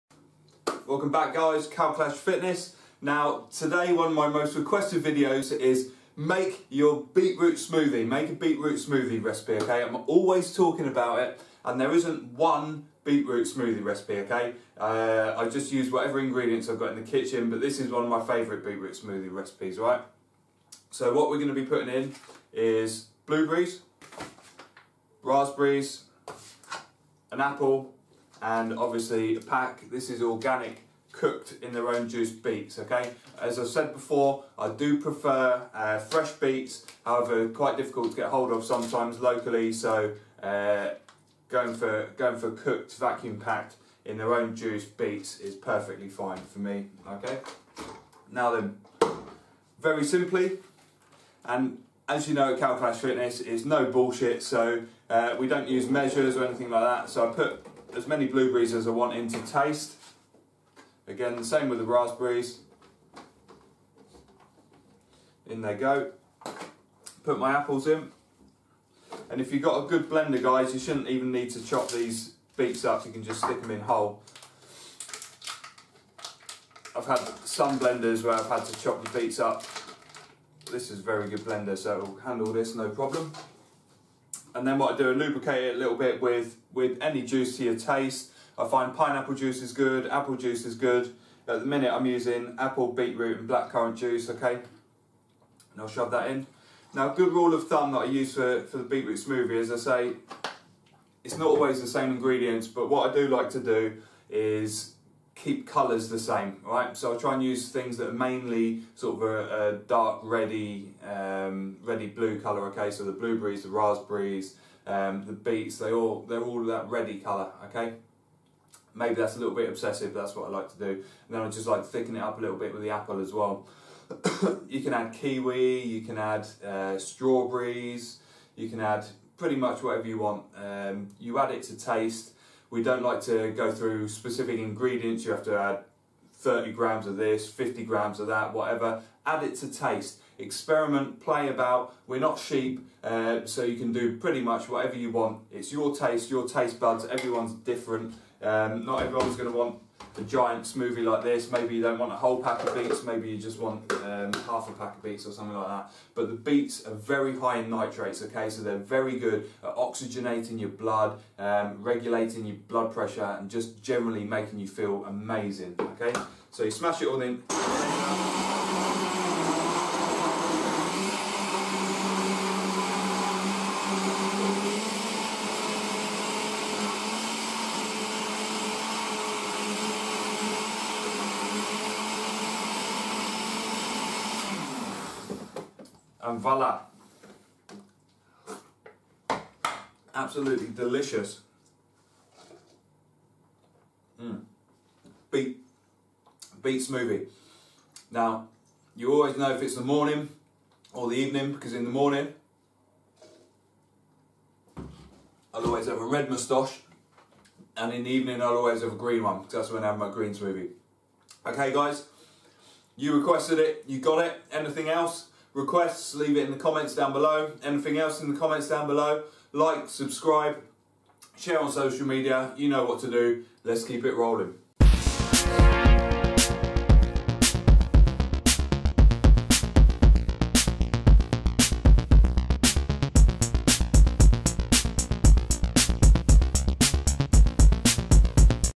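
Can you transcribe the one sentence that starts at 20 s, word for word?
So what we're going to be putting in is blueberries, raspberries, an apple, and obviously a pack.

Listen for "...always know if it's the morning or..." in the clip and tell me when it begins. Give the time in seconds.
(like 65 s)
199 s.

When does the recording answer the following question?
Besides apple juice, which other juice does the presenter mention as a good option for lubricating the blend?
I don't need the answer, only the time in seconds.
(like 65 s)
88 s.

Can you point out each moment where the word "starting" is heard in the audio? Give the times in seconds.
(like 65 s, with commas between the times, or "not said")
not said.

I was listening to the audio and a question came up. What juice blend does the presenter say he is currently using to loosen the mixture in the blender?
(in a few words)
apple, beetroot and blackcurrant.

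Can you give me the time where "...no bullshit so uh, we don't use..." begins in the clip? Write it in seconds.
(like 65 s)
53 s.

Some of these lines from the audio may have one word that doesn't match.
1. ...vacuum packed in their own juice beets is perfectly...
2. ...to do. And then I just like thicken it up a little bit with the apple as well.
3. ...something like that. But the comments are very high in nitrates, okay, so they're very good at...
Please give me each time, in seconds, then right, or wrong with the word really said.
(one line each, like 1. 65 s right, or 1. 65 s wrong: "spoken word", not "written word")
1. 42 s right
2. 120 s right
3. 155 s wrong: "beets", not "comments".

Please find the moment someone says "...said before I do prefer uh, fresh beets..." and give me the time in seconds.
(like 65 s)
33 s.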